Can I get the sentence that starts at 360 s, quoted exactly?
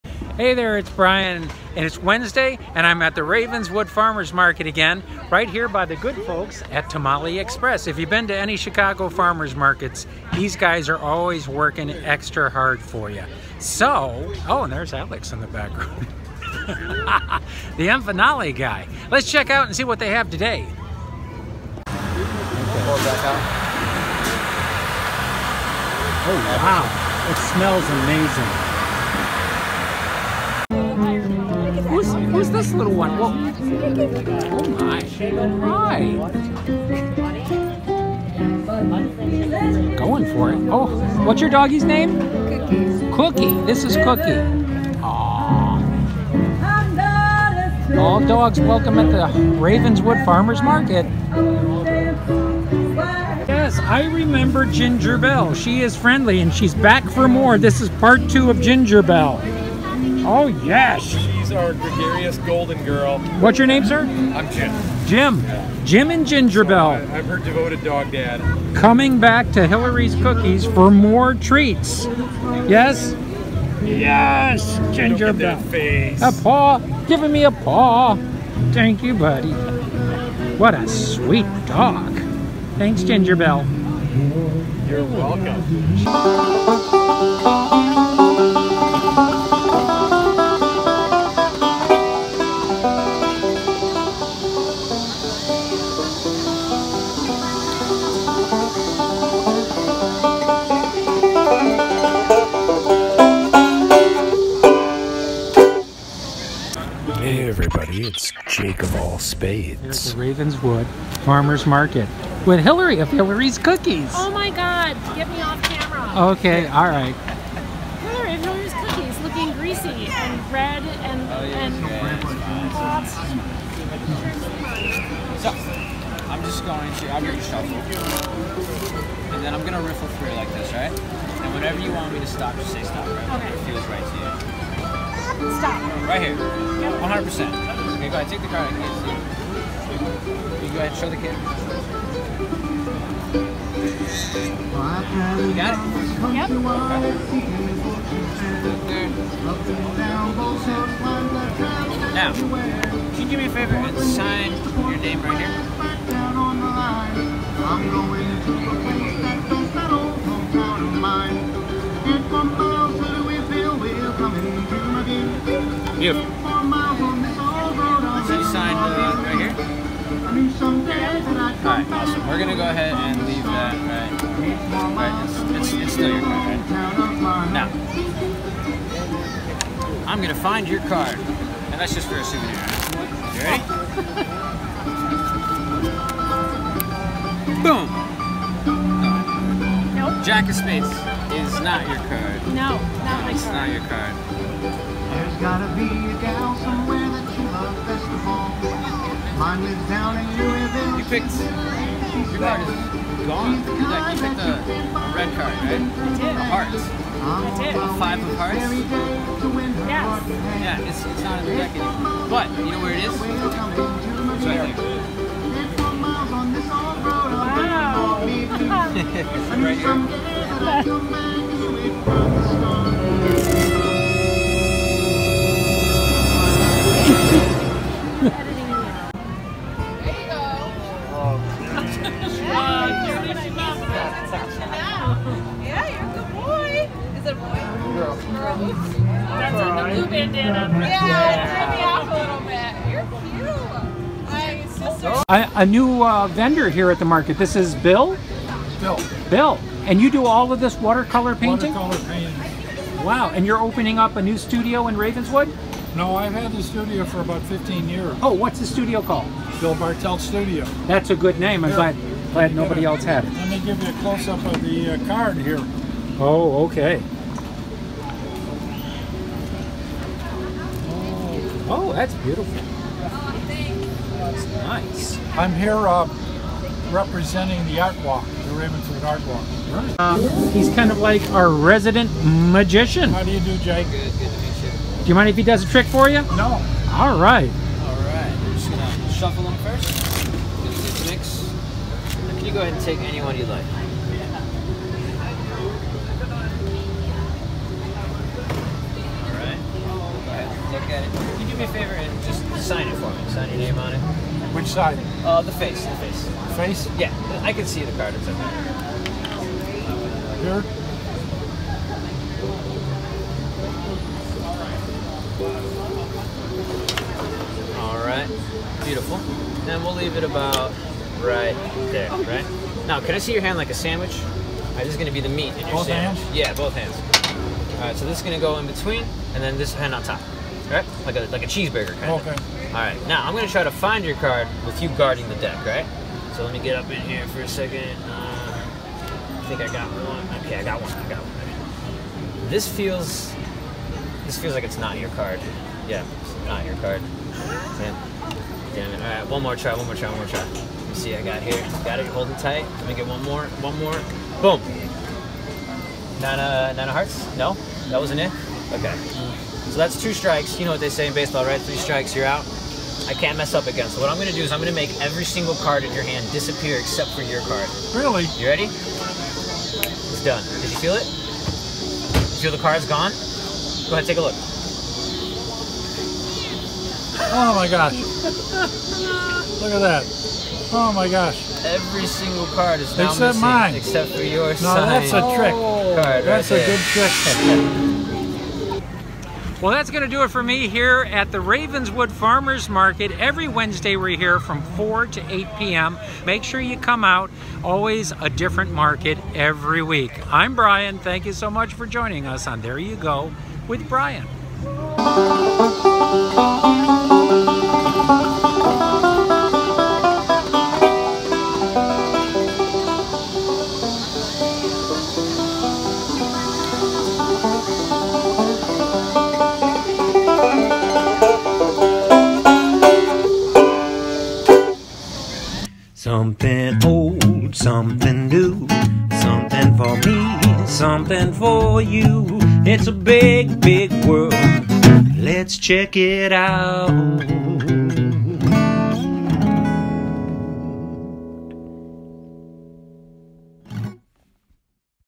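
You know what they say in baseball, right?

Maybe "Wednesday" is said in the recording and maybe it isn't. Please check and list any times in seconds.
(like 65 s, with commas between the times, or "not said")
2 s, 393 s.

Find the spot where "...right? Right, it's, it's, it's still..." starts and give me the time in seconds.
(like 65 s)
173 s.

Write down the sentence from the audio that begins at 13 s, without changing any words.
So, oh, and there's Alex in the background.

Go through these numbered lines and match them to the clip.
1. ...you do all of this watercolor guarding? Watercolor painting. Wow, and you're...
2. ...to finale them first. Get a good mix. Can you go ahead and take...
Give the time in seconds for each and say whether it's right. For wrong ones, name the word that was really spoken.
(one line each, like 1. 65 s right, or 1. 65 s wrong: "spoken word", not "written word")
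1. 250 s wrong: "painting", not "guarding"
2. 288 s wrong: "shuffle", not "finale".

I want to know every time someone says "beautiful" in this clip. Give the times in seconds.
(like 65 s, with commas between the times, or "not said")
272 s, 318 s.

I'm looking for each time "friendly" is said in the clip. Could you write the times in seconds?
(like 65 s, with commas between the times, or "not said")
55 s.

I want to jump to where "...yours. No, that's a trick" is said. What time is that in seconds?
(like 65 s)
384 s.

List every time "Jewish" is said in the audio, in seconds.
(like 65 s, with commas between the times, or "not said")
not said.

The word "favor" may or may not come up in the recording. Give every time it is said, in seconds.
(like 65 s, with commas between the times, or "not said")
153 s, 301 s.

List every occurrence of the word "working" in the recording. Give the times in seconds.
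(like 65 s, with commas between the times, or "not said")
11 s.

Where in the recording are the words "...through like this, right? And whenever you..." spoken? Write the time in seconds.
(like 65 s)
130 s.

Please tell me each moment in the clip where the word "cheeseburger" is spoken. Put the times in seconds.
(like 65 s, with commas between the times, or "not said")
331 s.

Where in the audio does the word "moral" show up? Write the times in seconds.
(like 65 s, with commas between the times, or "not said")
not said.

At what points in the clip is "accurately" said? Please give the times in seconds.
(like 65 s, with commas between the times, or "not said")
not said.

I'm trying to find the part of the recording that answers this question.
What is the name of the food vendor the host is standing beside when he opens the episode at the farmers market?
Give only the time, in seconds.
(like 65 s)
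6 s.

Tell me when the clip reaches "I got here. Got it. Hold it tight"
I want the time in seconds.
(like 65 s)
351 s.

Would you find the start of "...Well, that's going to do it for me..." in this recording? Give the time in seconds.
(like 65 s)
389 s.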